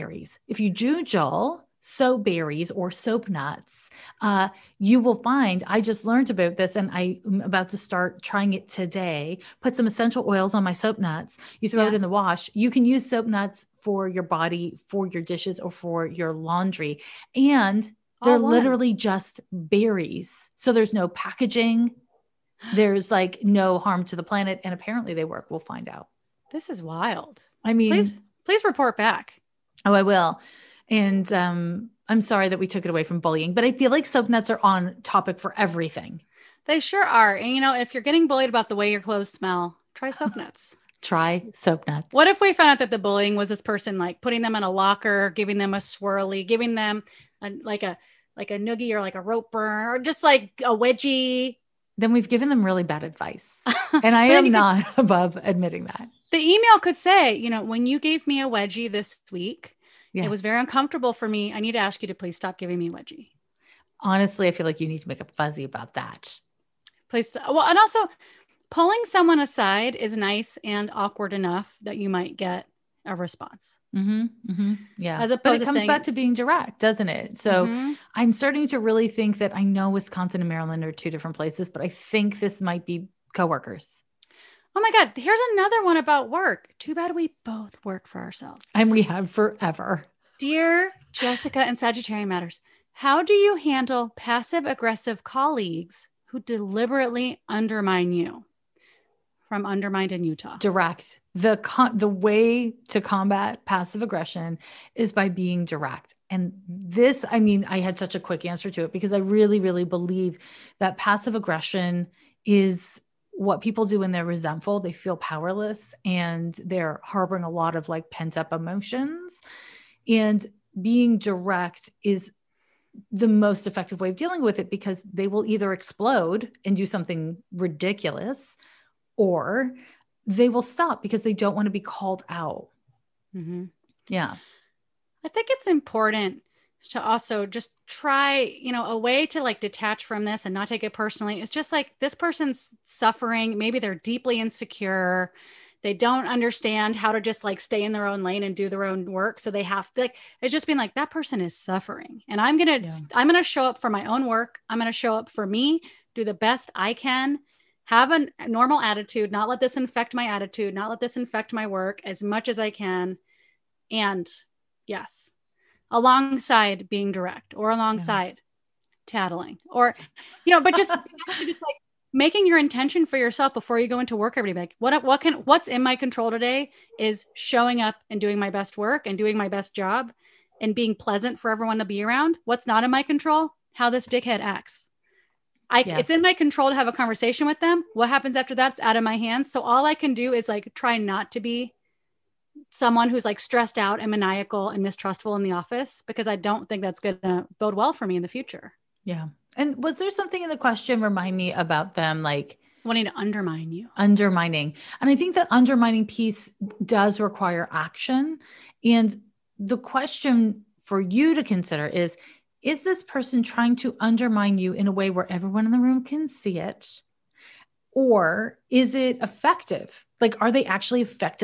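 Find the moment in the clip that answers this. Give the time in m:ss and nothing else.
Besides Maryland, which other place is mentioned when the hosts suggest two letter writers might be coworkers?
1:19.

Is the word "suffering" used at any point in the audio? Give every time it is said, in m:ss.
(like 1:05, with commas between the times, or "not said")
2:22, 2:31.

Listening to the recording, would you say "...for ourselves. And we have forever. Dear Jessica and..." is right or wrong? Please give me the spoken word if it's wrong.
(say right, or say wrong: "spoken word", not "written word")
right.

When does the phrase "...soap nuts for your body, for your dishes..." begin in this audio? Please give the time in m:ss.
0:13.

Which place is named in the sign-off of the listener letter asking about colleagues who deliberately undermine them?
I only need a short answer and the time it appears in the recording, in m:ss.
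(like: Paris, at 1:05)
Utah, at 1:40.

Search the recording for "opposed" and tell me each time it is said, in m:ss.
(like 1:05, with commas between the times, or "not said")
1:15.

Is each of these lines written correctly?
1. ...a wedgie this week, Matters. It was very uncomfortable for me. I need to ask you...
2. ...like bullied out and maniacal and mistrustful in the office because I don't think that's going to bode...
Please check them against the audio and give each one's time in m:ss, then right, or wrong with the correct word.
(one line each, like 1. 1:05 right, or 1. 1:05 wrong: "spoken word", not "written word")
1. 0:58 wrong: "Yes", not "Matters"
2. 3:13 wrong: "stressed", not "bullied".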